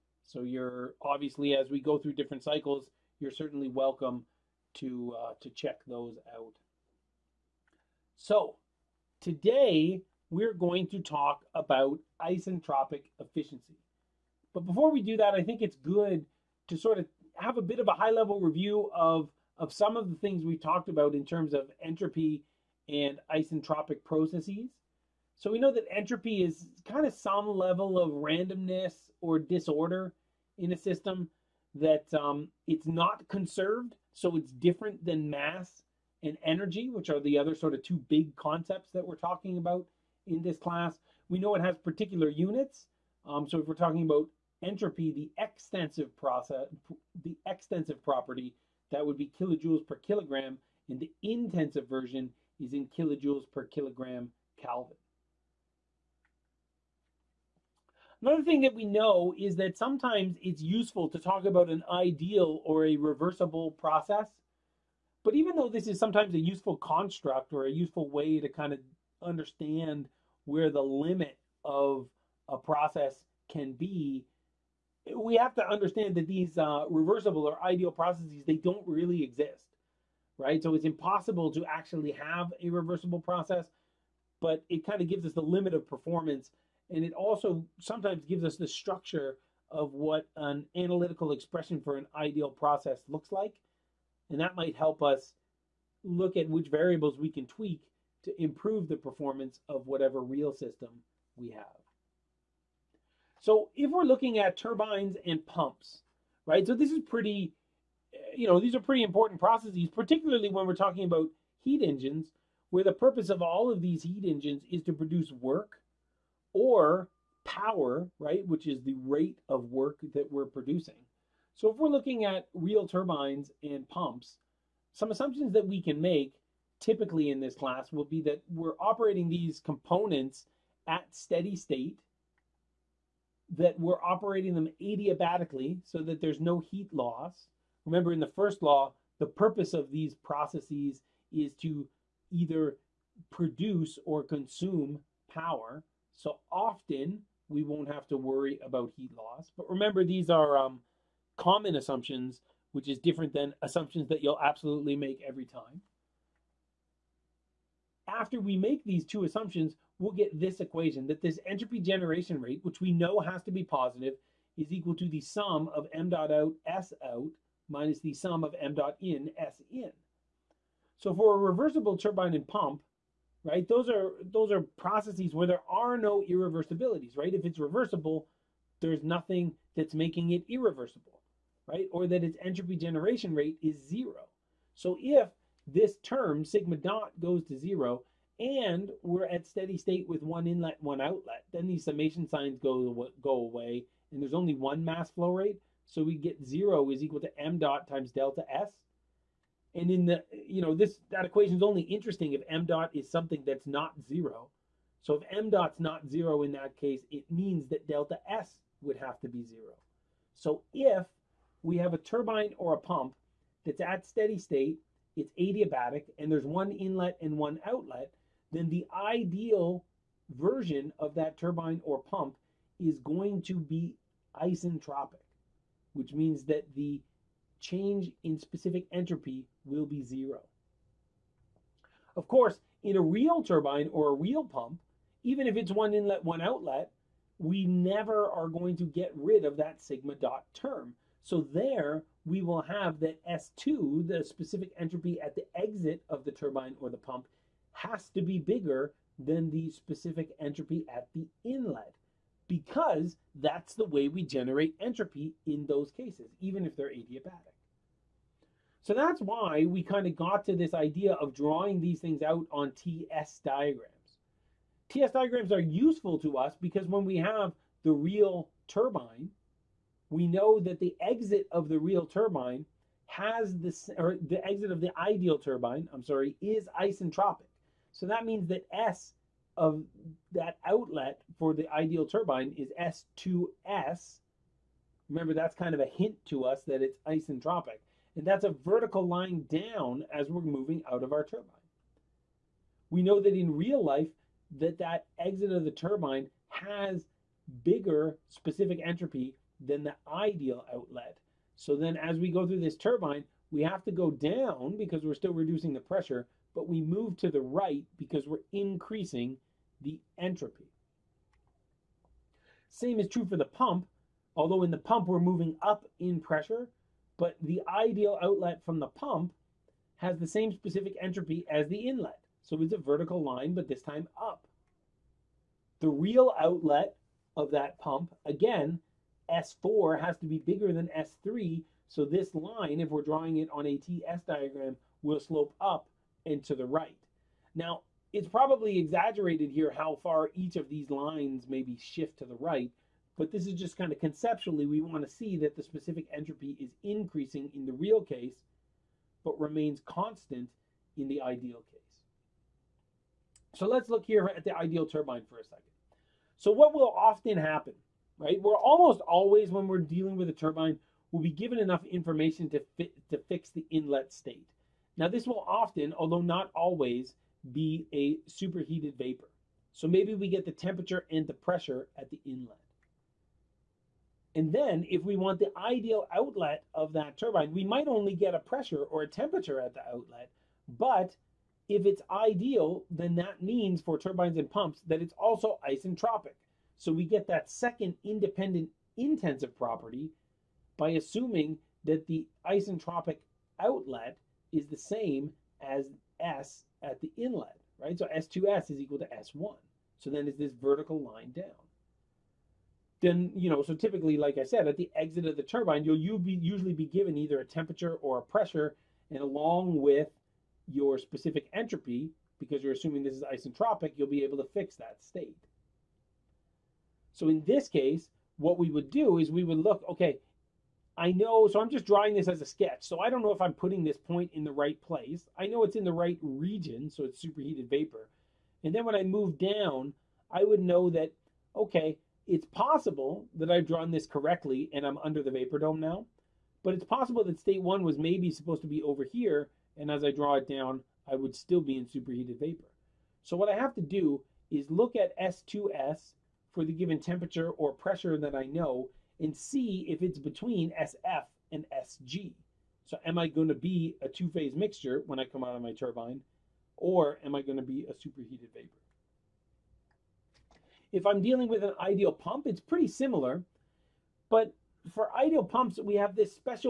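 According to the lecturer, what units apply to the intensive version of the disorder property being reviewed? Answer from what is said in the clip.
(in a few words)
Kilojoules per kilogram Kelvin.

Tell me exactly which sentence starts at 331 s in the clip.
So this line, if we're drawing it on a TS diagram, will slope up and to the right.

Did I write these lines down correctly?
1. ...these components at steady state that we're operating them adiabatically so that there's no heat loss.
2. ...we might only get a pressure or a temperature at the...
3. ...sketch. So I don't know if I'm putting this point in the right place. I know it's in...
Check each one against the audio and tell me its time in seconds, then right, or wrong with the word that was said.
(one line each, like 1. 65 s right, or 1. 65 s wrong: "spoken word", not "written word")
1. 129 s right
2. 377 s right
3. 422 s right.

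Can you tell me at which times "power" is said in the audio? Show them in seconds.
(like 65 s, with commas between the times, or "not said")
117 s, 145 s.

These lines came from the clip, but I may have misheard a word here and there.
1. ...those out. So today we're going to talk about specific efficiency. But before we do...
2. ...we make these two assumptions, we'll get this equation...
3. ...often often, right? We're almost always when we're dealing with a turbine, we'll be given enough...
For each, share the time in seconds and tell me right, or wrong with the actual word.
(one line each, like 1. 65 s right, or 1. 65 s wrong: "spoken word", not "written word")
1. 5 s wrong: "isentropic", not "specific"
2. 158 s right
3. 356 s wrong: "happen", not "often".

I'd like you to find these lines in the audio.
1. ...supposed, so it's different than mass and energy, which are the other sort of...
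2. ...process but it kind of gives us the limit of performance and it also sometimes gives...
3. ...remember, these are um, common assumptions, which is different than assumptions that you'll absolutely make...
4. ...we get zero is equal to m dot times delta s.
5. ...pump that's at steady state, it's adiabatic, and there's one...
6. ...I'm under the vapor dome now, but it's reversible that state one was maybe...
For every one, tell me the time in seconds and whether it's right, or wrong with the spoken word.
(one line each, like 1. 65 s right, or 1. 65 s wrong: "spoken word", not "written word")
1. 33 s wrong: "conserved", not "supposed"
2. 83 s right
3. 149 s right
4. 196 s right
5. 212 s right
6. 434 s wrong: "possible", not "reversible".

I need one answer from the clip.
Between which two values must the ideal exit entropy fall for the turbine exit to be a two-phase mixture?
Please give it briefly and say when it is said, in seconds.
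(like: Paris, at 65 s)
SF and SG, at 450 s.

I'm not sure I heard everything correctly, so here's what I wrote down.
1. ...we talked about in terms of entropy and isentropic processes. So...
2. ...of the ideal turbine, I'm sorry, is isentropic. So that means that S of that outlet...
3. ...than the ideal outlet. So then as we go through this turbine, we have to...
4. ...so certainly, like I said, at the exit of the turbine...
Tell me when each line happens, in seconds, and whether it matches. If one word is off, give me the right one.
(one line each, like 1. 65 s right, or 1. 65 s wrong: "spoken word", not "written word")
1. 20 s right
2. 274 s right
3. 299 s right
4. 403 s wrong: "typically", not "certainly".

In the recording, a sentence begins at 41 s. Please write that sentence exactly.
We know it has particular units.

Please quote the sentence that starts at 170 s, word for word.
So for a reversible turbine and pump, right, those are those are processes where there are no irreversibilities, right?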